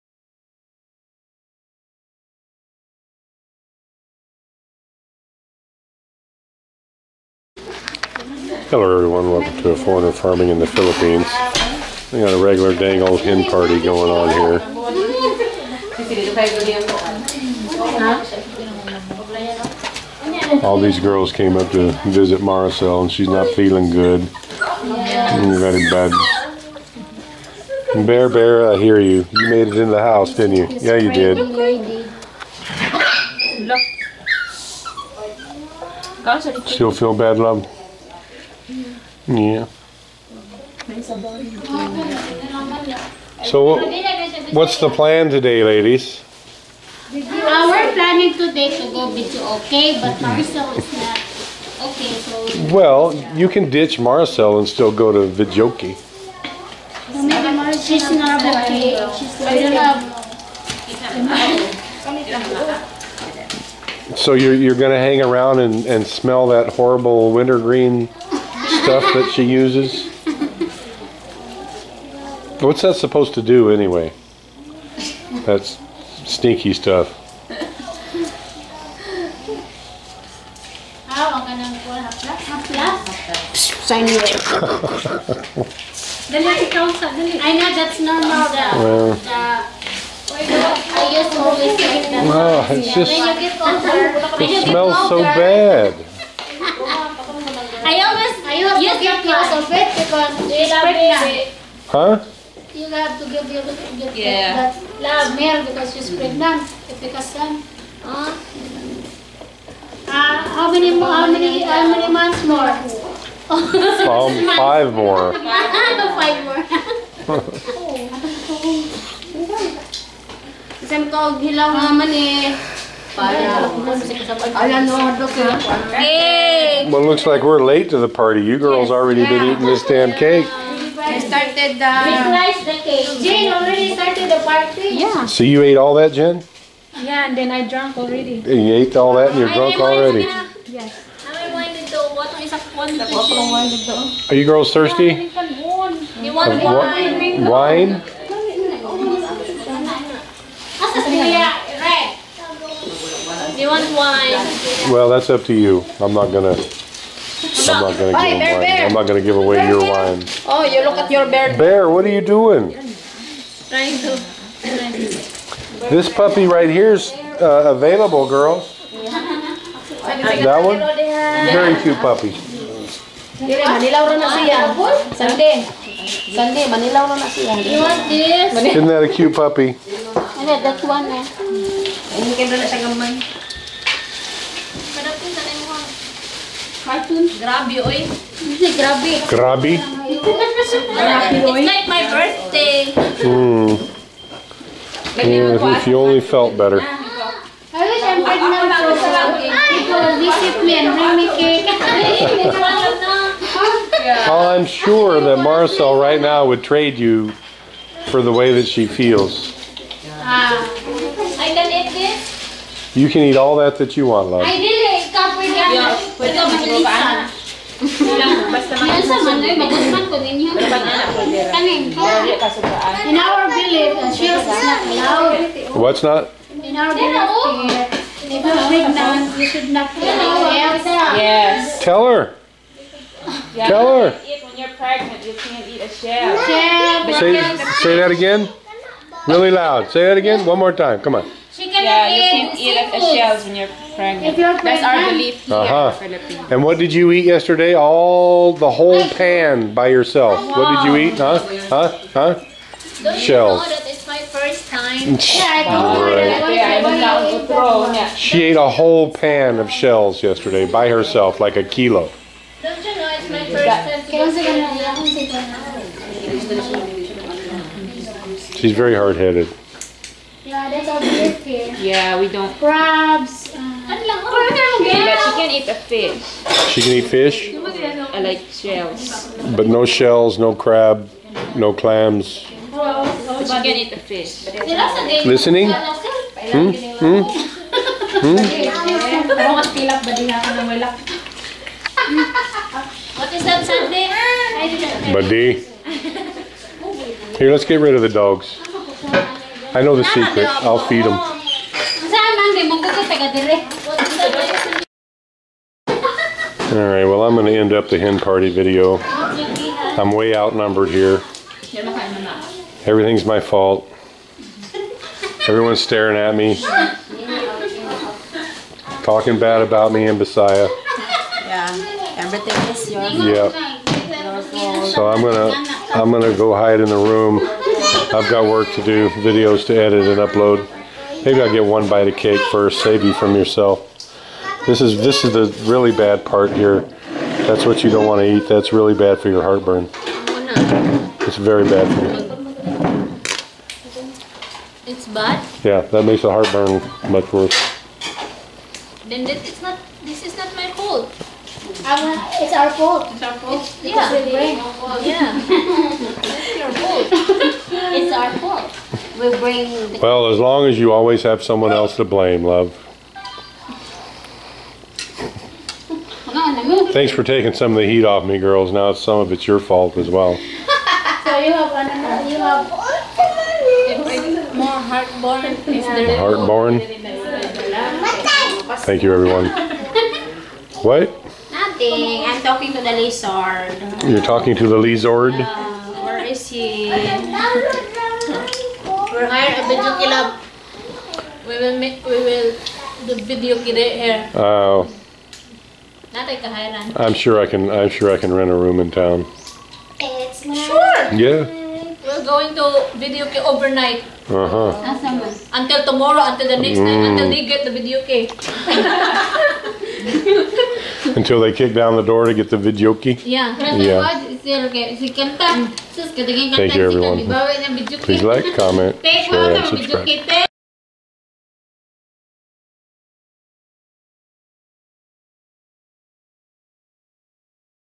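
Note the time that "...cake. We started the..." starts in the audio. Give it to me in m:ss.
2:10.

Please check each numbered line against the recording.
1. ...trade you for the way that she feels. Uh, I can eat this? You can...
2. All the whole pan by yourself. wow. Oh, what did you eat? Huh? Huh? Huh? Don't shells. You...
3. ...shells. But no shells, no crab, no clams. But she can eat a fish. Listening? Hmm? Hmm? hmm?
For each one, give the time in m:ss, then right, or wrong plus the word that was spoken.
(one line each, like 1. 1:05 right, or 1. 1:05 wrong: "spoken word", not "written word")
1. 3:26 right
2. 4:07 right
3. 4:38 right.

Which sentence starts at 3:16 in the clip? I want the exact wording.
Ah, I wish I'm pregnant for Because visit me and bring me cake.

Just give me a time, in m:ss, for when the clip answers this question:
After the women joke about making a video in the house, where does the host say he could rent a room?
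6:38.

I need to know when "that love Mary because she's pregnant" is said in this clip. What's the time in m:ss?
1:44.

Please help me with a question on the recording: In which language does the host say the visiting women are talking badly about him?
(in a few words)
Bisaya.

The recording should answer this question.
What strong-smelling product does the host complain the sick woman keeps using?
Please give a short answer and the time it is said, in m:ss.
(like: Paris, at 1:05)
Wintergreen, at 1:07.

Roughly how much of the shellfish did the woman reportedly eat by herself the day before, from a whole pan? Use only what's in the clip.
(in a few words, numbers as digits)
A kilo.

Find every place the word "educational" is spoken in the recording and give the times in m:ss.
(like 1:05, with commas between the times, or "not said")
not said.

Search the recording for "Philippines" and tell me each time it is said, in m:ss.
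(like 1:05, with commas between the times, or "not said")
0:10, 4:06.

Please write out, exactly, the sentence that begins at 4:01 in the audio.
Come on yeah, you can eat at the shells when you're pregnant.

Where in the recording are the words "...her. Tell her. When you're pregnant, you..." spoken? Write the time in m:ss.
3:52.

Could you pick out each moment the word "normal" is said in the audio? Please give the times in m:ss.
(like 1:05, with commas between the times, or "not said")
1:27.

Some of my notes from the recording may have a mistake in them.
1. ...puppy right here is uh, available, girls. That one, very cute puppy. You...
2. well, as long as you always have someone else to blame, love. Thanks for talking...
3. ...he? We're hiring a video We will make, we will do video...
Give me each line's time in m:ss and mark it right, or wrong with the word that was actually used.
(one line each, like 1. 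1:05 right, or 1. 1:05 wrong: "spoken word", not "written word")
1. 2:46 right
2. 5:59 wrong: "taking", not "talking"
3. 6:26 right.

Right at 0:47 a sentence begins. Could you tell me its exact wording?
Uh, we're planning today to go videoke, but mm-hmm.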